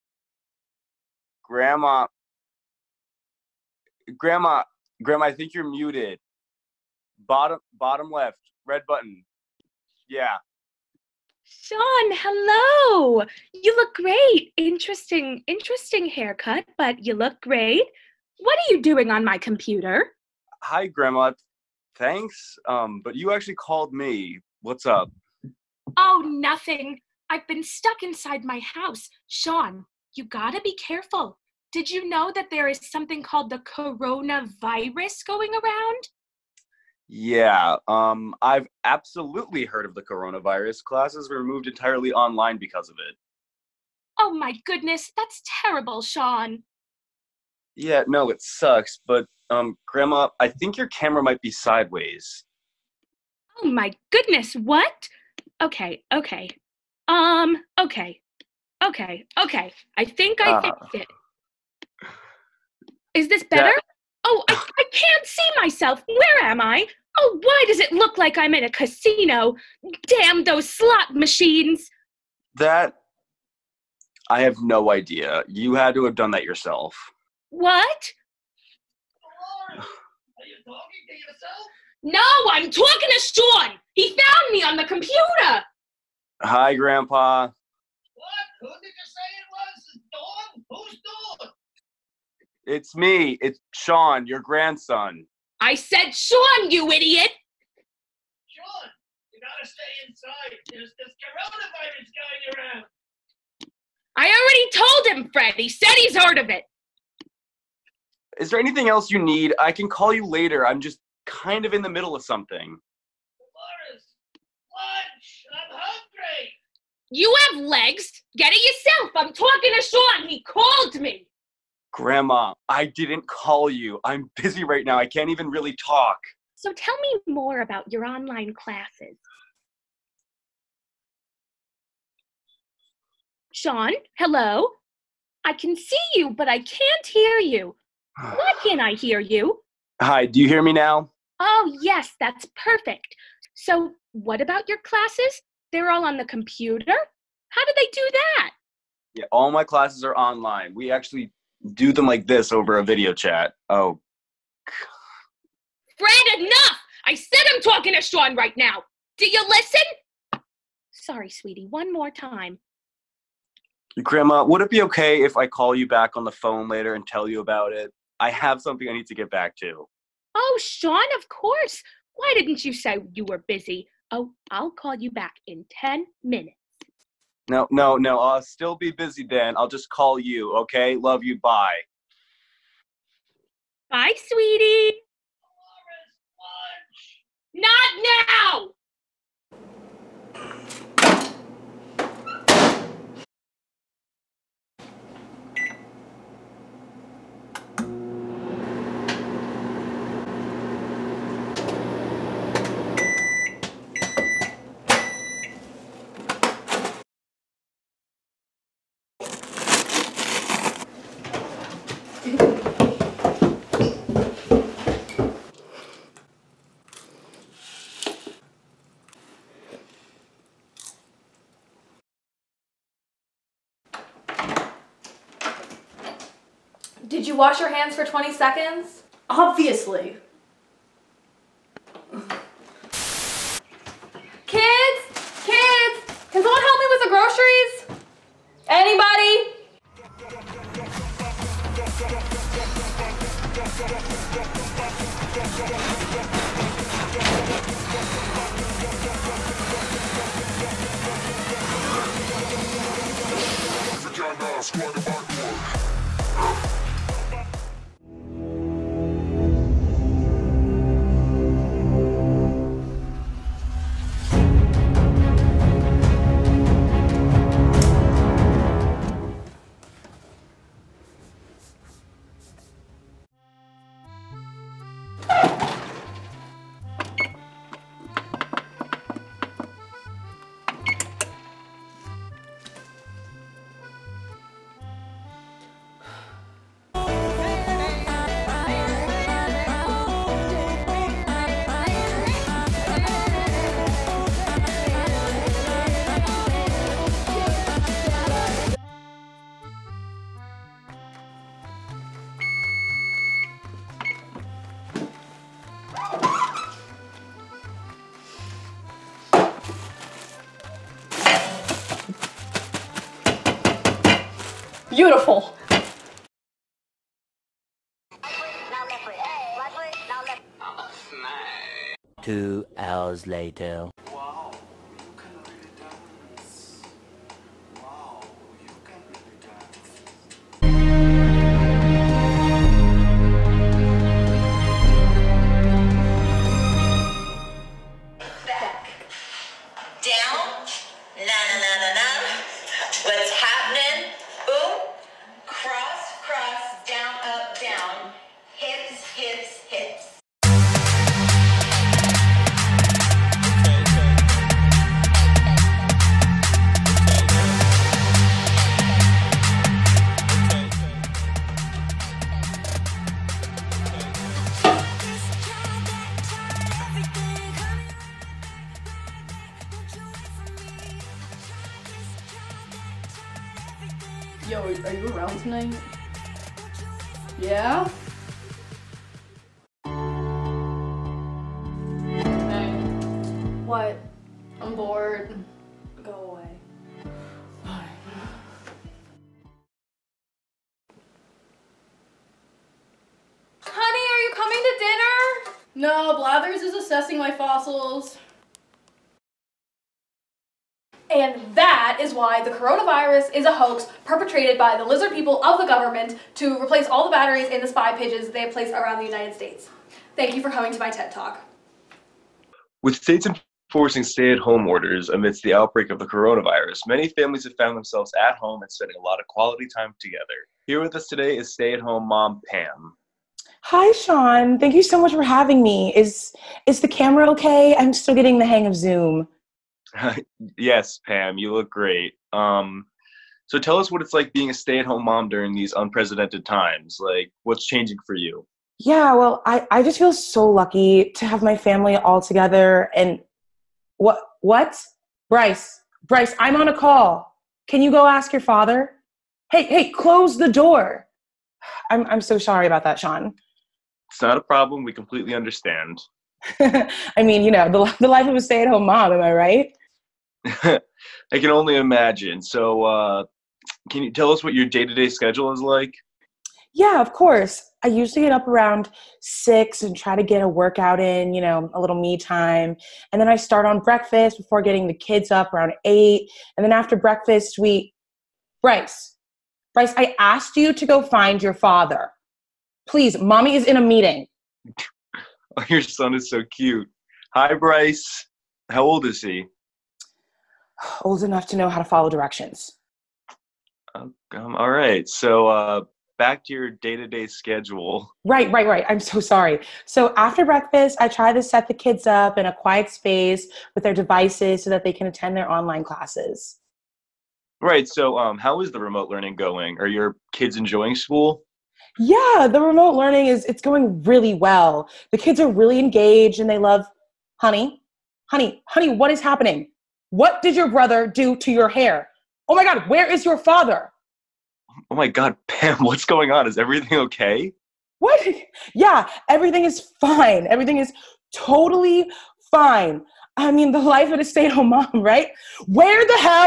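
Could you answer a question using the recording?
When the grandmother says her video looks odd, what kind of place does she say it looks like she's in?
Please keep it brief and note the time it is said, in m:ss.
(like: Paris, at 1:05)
A casino, at 1:08.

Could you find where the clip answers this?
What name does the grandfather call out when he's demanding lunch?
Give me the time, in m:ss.
1:52.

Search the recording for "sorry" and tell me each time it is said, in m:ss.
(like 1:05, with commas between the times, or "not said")
2:40, 7:32, 8:19.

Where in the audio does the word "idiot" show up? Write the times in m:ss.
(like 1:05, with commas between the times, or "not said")
1:36.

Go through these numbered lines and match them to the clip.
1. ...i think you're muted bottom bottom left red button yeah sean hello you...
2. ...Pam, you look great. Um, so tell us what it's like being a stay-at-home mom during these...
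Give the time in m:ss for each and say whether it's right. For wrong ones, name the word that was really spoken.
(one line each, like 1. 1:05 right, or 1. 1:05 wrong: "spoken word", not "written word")
1. 0:05 right
2. 7:11 right.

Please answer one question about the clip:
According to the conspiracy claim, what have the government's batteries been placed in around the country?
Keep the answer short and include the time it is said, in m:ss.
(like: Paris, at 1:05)
Spy pigeons, at 6:47.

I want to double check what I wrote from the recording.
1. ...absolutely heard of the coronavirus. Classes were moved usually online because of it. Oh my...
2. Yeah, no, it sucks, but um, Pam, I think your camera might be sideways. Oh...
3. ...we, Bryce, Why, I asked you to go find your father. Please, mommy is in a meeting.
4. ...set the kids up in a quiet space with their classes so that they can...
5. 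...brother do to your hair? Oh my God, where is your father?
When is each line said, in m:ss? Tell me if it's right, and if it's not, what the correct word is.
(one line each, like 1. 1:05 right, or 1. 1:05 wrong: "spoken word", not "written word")
1. 0:38 wrong: "entirely", not "usually"
2. 0:47 wrong: "Grandma", not "Pam"
3. 7:57 wrong: "Bryce", not "Why"
4. 8:21 wrong: "devices", not "classes"
5. 8:40 right.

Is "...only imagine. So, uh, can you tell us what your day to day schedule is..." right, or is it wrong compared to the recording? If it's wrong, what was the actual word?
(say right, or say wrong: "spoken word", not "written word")
right.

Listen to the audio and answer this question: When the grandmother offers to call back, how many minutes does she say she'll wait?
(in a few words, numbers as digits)
10.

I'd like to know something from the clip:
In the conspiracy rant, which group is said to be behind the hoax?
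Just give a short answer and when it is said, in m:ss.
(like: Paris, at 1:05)
Lizard people, at 6:44.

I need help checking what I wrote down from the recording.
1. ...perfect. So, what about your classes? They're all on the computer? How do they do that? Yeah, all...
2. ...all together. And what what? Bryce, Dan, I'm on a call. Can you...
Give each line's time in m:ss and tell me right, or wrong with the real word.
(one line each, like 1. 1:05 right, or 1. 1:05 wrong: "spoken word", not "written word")
1. 2:22 right
2. 7:21 wrong: "Bryce", not "Dan".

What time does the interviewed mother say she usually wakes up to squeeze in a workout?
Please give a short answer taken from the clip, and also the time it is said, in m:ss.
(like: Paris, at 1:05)
6, at 7:49.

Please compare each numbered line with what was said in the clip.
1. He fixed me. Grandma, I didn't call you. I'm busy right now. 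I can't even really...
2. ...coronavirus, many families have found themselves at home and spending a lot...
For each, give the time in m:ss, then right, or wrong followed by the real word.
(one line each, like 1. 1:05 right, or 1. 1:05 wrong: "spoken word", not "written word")
1. 2:00 wrong: "called", not "fixed"
2. 6:56 right.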